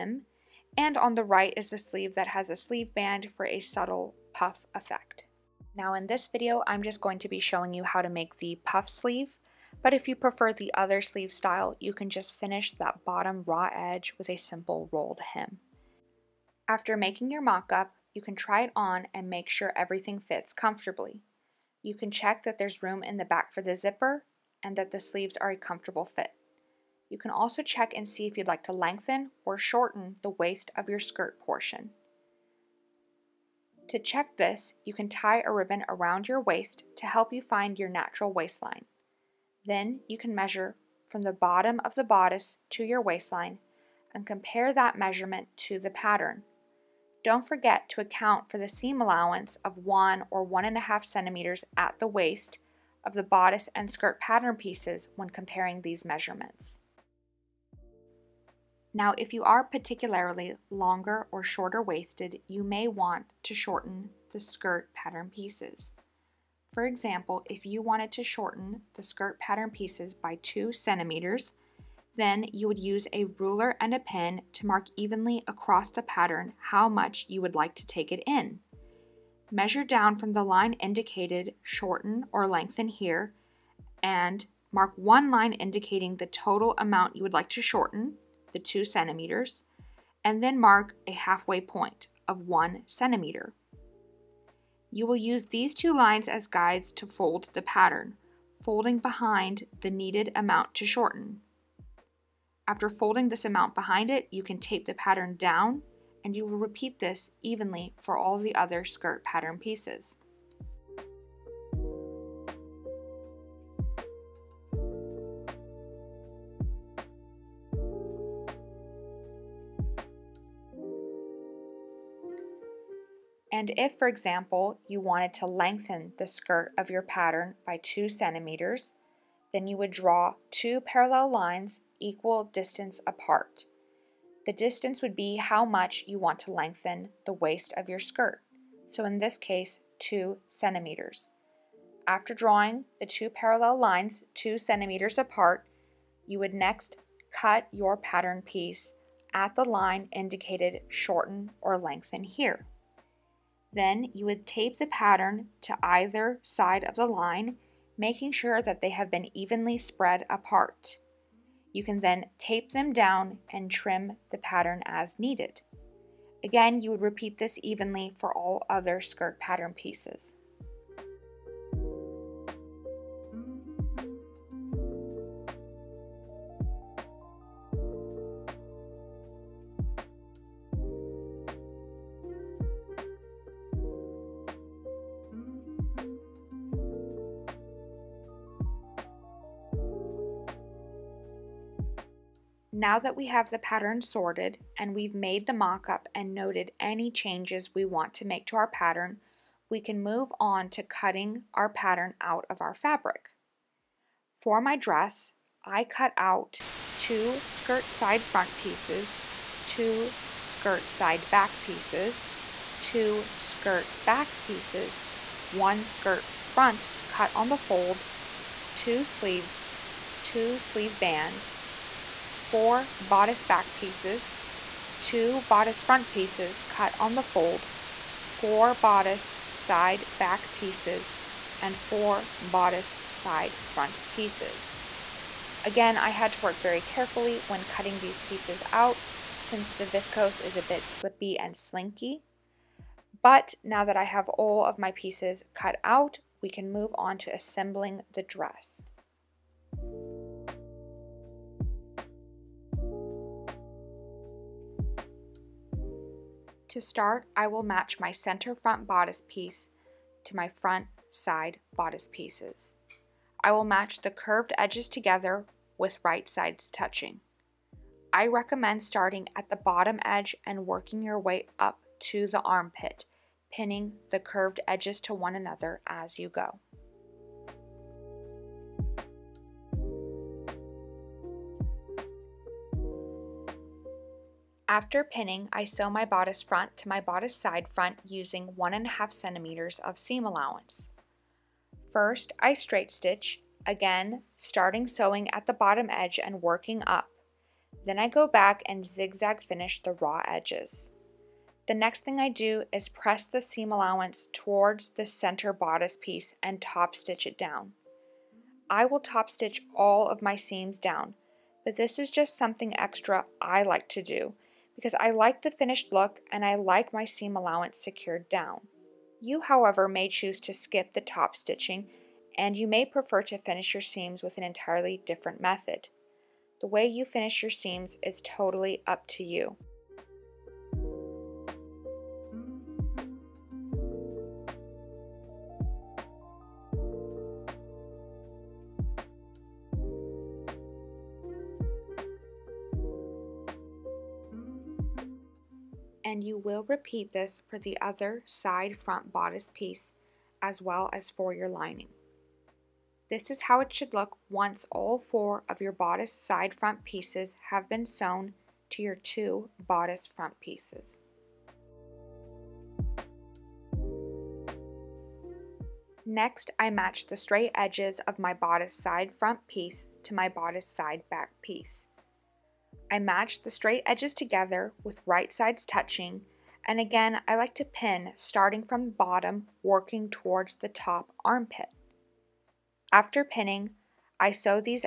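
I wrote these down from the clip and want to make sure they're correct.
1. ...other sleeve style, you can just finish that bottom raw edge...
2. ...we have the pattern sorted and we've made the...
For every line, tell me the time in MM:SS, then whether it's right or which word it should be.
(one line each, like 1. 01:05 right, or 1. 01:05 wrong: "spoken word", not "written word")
1. 00:10 right
2. 03:13 right.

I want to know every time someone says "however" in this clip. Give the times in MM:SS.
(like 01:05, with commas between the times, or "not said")
05:19.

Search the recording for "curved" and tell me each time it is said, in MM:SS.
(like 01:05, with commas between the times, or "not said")
04:24, 04:34.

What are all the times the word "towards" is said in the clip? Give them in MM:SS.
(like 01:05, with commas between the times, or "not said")
05:04, 06:20.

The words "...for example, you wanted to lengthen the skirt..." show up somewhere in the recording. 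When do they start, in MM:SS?
02:03.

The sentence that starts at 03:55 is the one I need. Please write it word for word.
Again, I had to work very carefully when cutting these pieces out since the viscose is a bit slippy and slinky.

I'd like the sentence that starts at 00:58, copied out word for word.
Now, if you are particularly longer or shorter waisted, you may want to shorten the skirt pattern pieces.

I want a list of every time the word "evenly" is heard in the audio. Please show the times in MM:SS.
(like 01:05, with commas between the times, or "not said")
01:14, 01:47, 02:39, 02:47.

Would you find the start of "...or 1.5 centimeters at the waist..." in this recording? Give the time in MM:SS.
00:50.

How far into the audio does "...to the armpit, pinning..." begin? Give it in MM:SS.
04:32.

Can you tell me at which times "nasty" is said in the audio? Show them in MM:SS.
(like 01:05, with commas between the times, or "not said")
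not said.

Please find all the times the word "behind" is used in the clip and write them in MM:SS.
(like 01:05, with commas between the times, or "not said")
01:38, 01:43.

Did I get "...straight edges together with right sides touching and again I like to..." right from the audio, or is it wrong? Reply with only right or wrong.
right.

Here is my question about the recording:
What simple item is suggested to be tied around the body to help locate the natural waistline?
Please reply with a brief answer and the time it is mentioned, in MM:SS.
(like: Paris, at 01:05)
ribbon, at 00:35.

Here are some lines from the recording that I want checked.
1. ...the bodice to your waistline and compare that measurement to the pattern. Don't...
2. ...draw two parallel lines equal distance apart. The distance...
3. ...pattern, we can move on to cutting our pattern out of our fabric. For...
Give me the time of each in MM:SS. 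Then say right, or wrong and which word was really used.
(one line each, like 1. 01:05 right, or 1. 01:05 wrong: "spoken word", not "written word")
1. 00:41 right
2. 02:09 right
3. 03:18 right.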